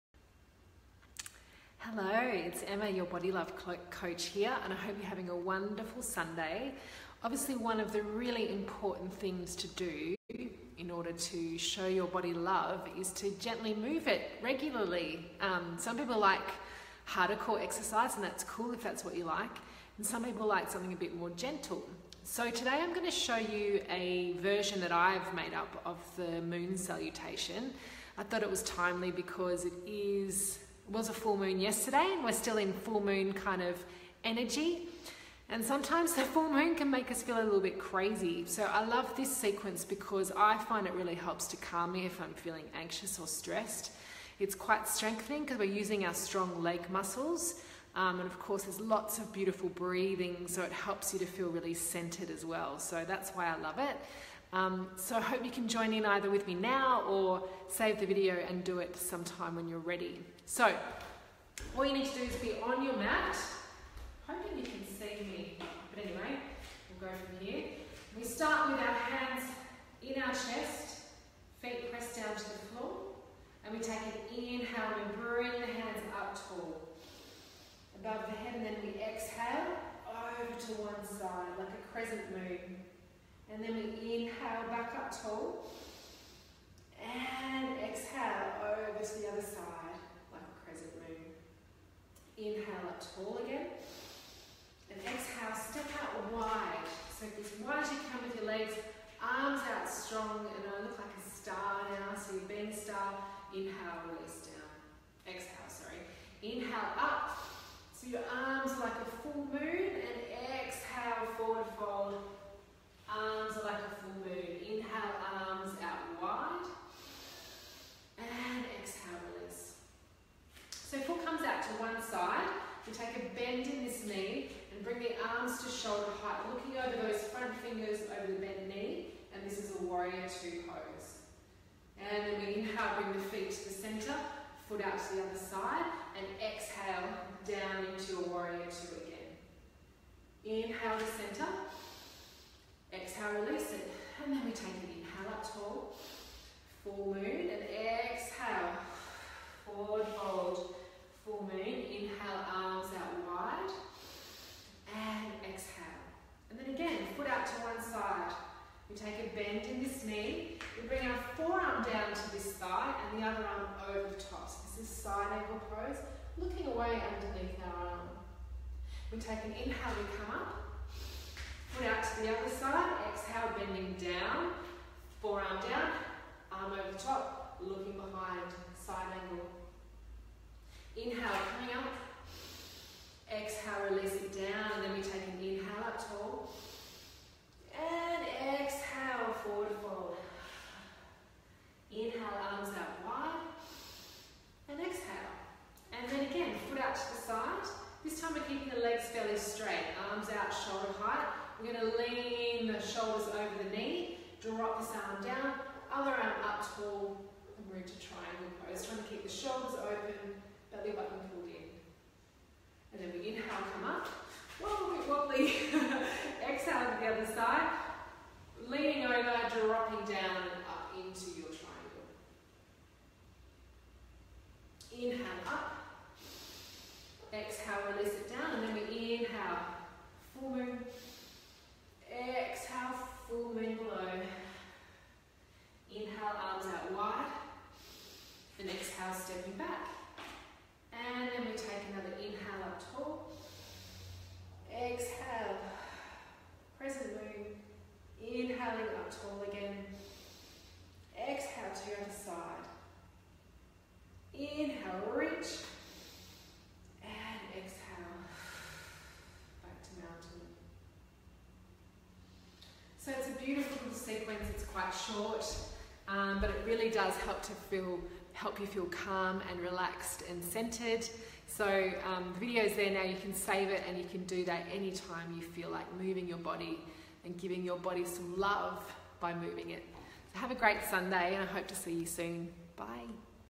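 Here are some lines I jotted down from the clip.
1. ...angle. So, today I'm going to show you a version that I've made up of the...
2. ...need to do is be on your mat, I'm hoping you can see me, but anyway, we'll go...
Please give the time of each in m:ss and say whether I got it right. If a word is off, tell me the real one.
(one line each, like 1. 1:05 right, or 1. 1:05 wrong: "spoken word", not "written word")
1. 0:21 wrong: "gentle", not "angle"
2. 1:01 right.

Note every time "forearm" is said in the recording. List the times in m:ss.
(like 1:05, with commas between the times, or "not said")
2:41, 2:55.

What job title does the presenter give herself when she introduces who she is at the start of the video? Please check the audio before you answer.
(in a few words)
Body Love Coach.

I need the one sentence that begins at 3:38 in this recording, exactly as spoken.
Leaning over, dropping down and up into your triangle.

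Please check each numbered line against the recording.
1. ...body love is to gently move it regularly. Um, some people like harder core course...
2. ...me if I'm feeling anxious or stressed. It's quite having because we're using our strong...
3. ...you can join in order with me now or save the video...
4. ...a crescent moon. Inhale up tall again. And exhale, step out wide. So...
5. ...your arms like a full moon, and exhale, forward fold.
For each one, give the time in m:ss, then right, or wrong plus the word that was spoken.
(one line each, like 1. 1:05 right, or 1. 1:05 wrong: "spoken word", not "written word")
1. 0:12 wrong: "exercise", not "course"
2. 0:41 wrong: "strengthening", not "having"
3. 0:55 wrong: "either", not "order"
4. 1:30 right
5. 1:48 right.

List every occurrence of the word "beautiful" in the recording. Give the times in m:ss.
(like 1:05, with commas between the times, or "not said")
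0:49, 4:23.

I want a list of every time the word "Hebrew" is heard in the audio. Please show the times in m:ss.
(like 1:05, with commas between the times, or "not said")
not said.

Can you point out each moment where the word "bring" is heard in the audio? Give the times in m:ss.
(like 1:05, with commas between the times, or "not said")
1:15, 2:12, 2:40.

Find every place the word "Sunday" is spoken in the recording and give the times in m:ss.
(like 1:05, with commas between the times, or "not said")
0:06, 4:40.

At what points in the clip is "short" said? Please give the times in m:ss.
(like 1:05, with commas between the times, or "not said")
4:25.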